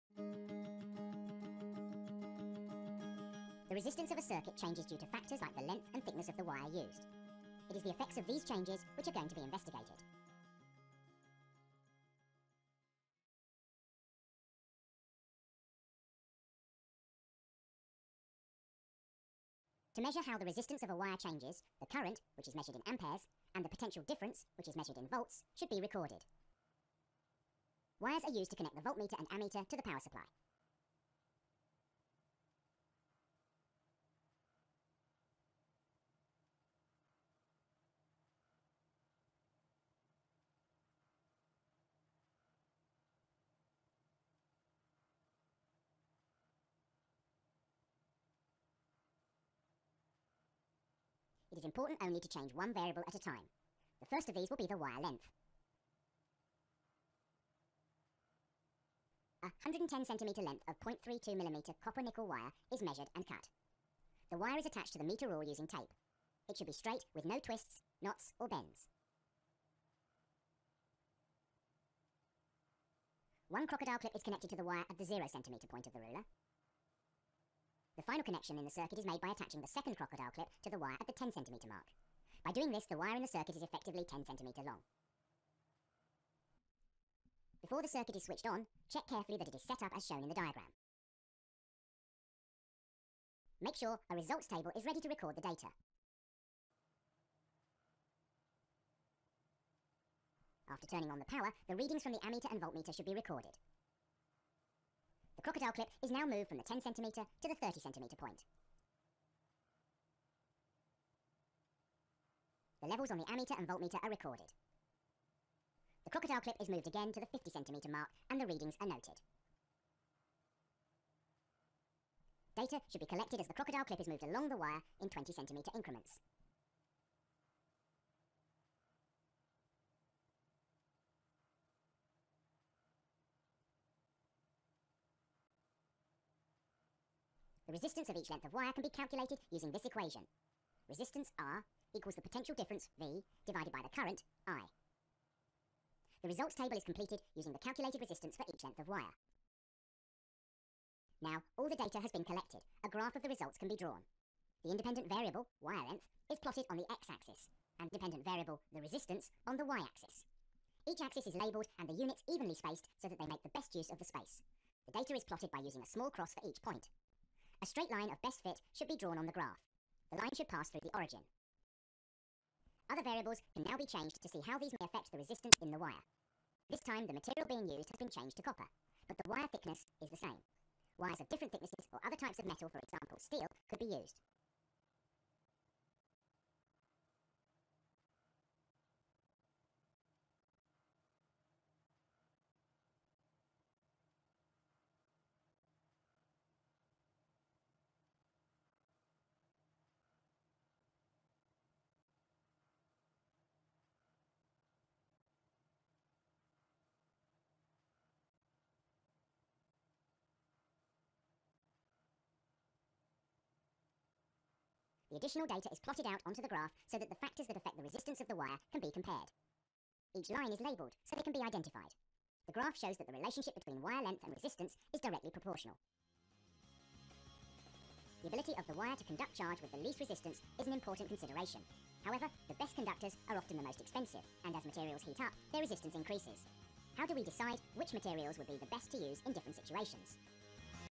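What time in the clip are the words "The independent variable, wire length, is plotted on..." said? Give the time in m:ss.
2:34.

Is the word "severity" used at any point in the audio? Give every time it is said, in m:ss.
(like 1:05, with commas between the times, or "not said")
not said.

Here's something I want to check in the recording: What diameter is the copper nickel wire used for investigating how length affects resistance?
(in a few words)
0.32mm.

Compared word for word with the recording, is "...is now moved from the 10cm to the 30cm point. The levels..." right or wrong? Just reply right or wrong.
right.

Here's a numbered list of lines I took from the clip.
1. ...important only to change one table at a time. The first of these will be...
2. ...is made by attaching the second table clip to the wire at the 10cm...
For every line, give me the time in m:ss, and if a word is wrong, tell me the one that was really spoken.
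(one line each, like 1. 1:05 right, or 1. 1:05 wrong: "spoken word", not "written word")
1. 0:51 wrong: "variable", not "table"
2. 1:18 wrong: "crocodile", not "table".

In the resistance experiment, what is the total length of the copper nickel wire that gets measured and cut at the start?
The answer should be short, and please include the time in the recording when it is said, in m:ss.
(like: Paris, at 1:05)
110cm, at 0:59.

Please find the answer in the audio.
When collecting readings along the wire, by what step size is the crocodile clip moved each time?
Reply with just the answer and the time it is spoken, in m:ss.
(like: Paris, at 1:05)
20cm, at 2:05.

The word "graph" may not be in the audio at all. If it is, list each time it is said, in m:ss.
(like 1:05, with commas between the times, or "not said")
2:32, 2:49, 3:36, 3:42.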